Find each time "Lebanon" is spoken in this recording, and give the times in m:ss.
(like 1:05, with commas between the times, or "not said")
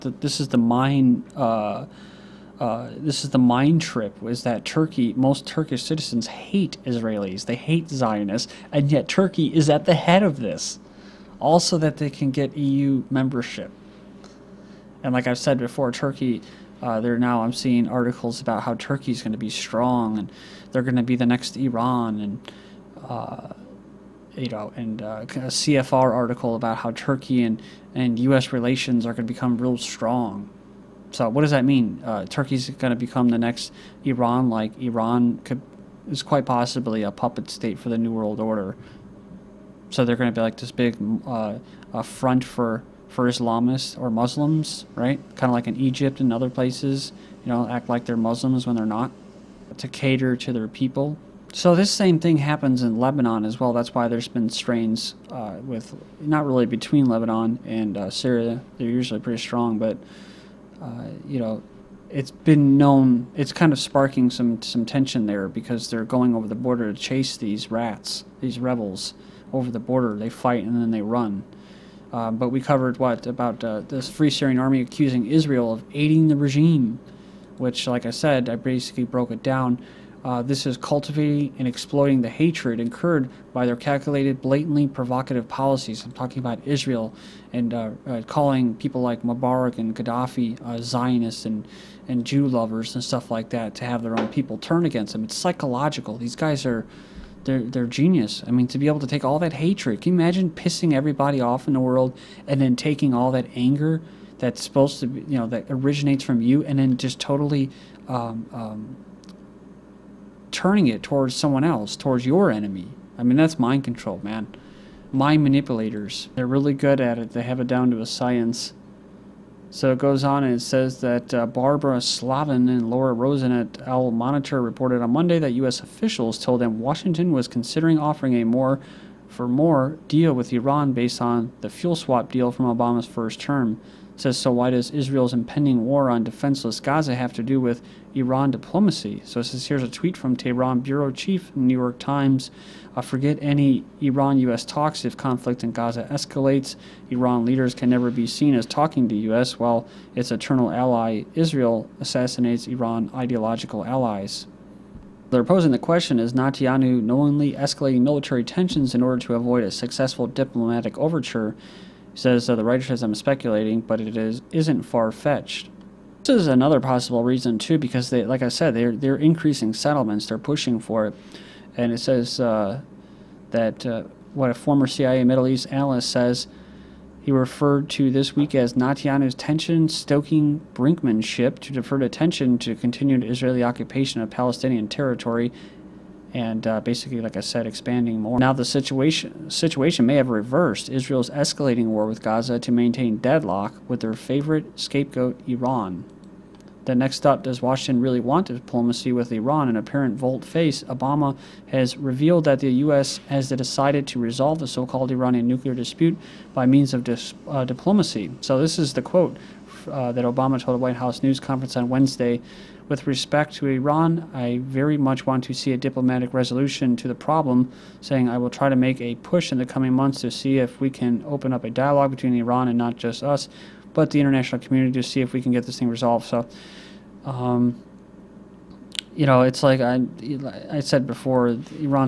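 0:52, 0:57.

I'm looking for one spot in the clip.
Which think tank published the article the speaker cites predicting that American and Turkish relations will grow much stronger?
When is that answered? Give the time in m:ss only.
0:25.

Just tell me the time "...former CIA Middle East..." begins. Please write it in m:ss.
2:54.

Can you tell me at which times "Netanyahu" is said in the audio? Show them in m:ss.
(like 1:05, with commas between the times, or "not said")
2:36, 2:58.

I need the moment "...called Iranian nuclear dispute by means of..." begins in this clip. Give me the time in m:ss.
3:24.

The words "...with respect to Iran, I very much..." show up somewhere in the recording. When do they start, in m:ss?
3:32.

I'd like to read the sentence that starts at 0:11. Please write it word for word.
Also, that they can get EU membership.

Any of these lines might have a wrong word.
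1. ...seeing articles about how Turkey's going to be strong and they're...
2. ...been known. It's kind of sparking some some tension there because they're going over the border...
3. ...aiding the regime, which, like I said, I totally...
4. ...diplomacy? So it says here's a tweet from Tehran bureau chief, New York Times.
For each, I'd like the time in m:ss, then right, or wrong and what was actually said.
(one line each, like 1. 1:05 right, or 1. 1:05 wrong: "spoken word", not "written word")
1. 0:17 right
2. 1:02 right
3. 1:15 wrong: "basically", not "totally"
4. 2:18 right.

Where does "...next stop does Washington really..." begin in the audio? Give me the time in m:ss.
3:16.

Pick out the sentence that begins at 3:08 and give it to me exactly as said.
Now the situation situation may have reversed.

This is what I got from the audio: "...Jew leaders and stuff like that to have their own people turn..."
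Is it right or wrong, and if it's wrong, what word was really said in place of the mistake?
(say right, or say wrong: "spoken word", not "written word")
wrong: "lovers", not "leaders".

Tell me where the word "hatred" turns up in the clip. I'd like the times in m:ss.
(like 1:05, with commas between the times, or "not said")
1:22, 1:39.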